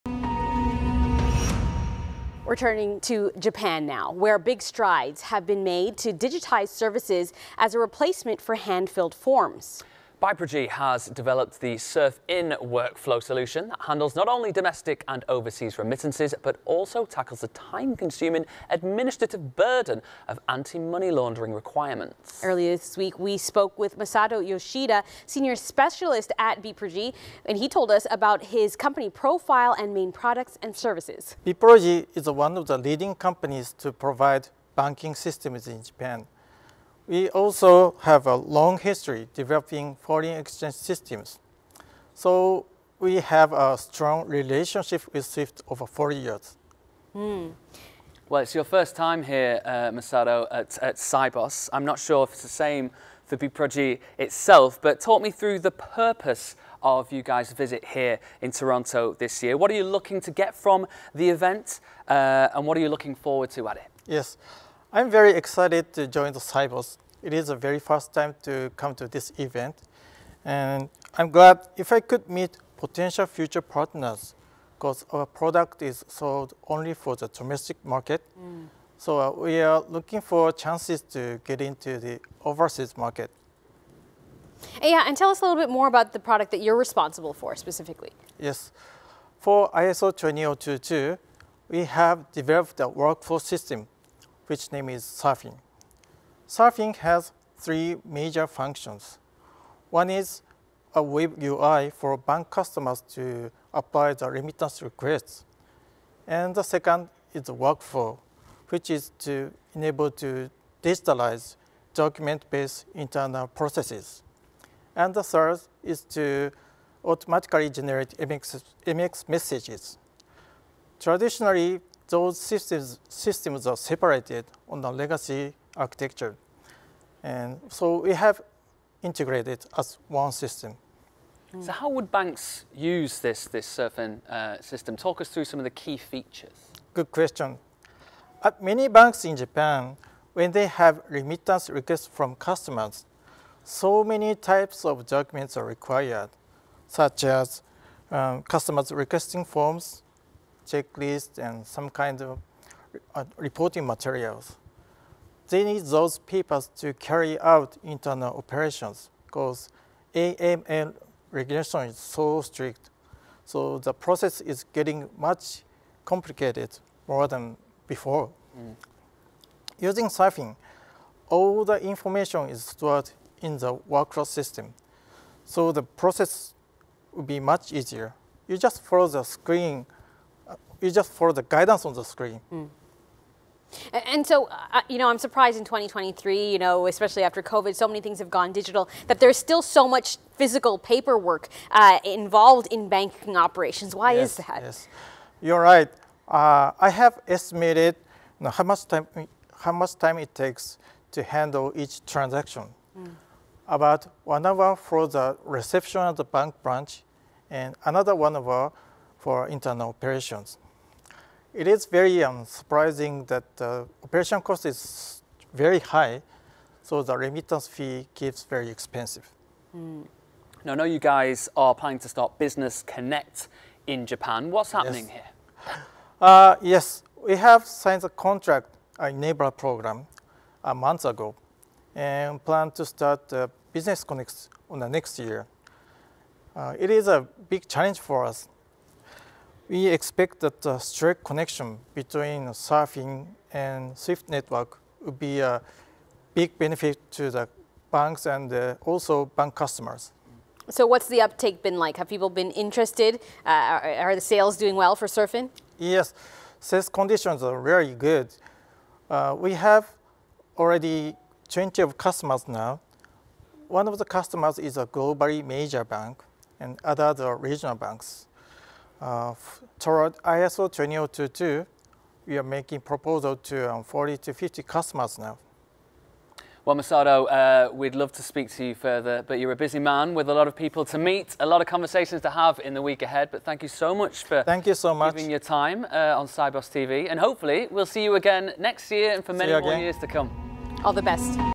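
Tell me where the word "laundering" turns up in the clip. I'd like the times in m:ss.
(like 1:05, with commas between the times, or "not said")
0:21.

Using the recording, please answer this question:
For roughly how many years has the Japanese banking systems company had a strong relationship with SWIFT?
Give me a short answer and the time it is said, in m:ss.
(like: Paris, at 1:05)
40 years, at 0:45.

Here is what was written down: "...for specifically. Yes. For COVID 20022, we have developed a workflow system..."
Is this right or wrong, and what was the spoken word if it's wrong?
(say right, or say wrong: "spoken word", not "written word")
wrong: "ISO", not "COVID".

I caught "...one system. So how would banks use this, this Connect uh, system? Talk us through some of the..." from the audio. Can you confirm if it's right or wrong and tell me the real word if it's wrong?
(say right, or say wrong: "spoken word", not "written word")
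wrong: "SurFIN", not "Connect".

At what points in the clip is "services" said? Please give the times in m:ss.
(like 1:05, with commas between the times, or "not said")
0:06, 0:30.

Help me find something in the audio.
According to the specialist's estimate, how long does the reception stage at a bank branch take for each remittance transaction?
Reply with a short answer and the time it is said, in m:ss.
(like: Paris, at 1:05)
1 hour, at 3:23.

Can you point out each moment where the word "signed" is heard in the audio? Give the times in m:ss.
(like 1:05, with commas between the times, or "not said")
3:47.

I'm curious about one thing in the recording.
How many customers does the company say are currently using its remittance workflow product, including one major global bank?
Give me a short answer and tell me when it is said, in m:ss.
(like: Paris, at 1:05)
20, at 4:21.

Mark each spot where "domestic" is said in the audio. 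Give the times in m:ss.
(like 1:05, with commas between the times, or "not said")
0:14, 1:17.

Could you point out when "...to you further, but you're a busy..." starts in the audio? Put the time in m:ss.
4:38.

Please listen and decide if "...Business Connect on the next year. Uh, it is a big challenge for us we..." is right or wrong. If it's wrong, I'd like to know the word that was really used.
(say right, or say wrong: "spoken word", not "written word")
right.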